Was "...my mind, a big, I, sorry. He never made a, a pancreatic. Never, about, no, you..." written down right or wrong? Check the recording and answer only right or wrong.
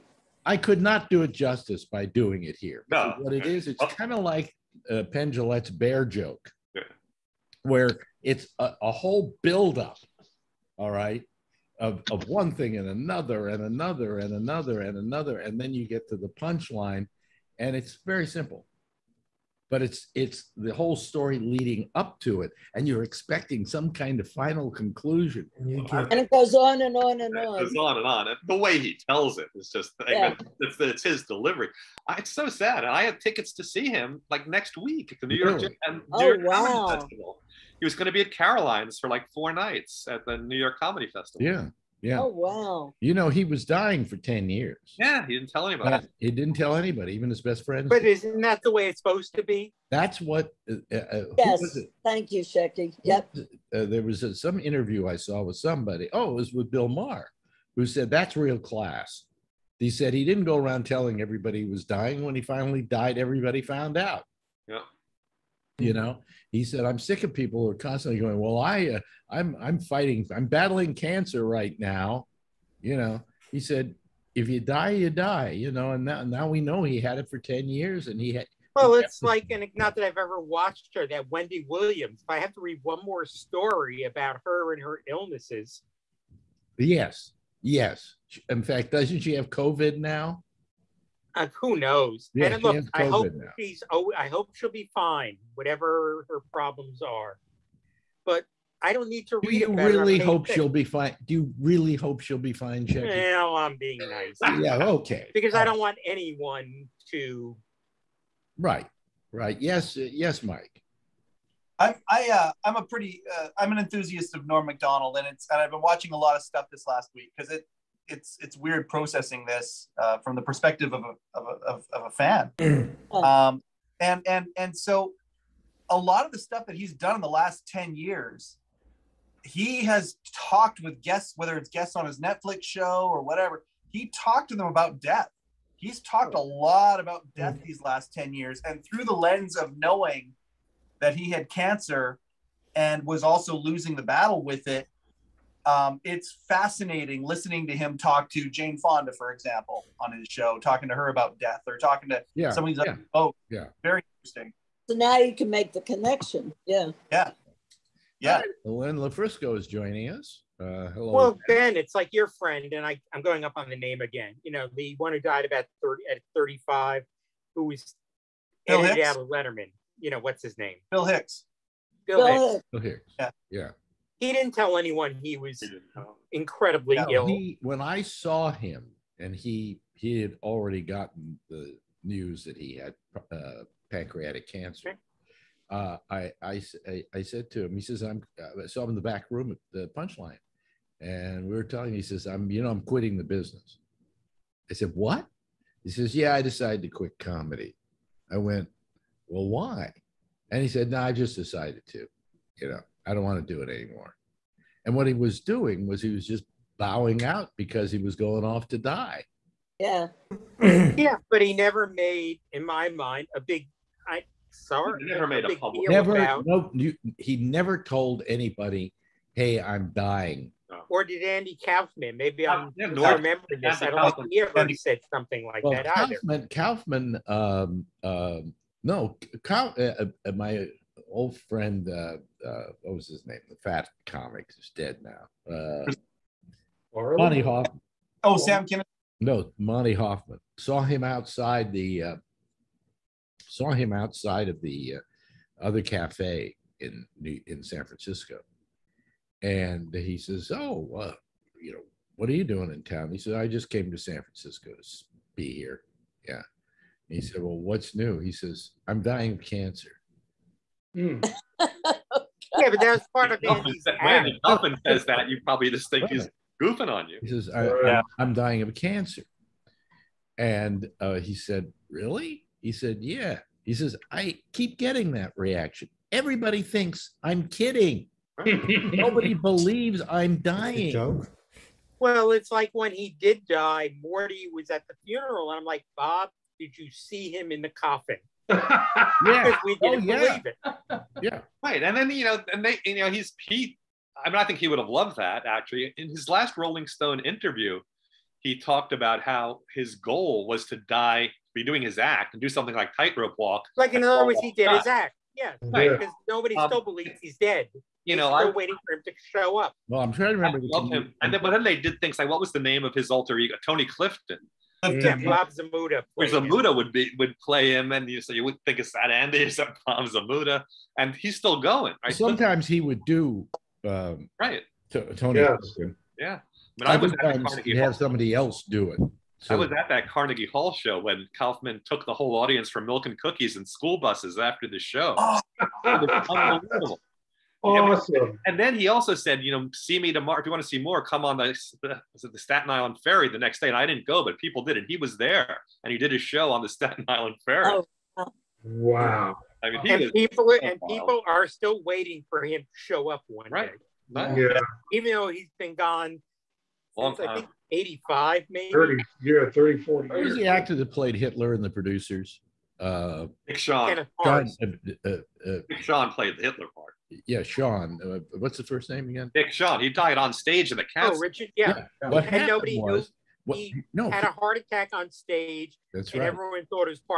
wrong.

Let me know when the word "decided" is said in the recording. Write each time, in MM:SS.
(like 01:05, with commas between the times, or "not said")
03:16, 03:21.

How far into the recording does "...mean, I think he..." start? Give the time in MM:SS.
04:54.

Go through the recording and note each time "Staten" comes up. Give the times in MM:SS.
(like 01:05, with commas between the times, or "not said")
05:42, 05:46.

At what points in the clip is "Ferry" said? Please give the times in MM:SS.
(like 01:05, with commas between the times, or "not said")
05:43, 05:47.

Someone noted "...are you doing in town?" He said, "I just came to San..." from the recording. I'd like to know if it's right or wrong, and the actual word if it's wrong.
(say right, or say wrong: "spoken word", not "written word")
right.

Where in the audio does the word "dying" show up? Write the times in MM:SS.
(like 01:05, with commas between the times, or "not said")
00:43, 01:01, 03:39, 04:19, 04:28, 04:40.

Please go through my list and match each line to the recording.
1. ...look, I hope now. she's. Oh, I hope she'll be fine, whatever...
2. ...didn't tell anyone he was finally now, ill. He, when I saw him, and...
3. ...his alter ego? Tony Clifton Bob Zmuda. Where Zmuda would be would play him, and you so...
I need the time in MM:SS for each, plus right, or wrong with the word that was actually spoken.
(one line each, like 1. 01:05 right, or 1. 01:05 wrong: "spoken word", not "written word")
1. 01:32 right
2. 02:54 wrong: "incredibly", not "finally"
3. 05:12 right.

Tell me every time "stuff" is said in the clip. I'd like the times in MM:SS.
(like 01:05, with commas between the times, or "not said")
01:56, 02:06.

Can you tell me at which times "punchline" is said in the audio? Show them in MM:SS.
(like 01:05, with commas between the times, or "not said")
00:16, 03:09.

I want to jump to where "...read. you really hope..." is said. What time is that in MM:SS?
01:39.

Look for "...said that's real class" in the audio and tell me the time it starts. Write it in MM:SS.
00:57.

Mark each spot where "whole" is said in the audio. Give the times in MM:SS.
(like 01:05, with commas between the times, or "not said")
00:08, 00:20, 05:32.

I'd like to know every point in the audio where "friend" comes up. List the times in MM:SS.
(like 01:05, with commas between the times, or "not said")
00:47, 02:42, 03:51.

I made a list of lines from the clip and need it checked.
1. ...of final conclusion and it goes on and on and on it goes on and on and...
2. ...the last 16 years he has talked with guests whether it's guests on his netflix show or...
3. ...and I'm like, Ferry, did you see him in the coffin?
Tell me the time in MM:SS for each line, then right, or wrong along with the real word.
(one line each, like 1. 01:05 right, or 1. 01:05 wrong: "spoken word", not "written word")
1. 00:24 right
2. 02:07 wrong: "10", not "16"
3. 04:45 wrong: "Bob", not "Ferry".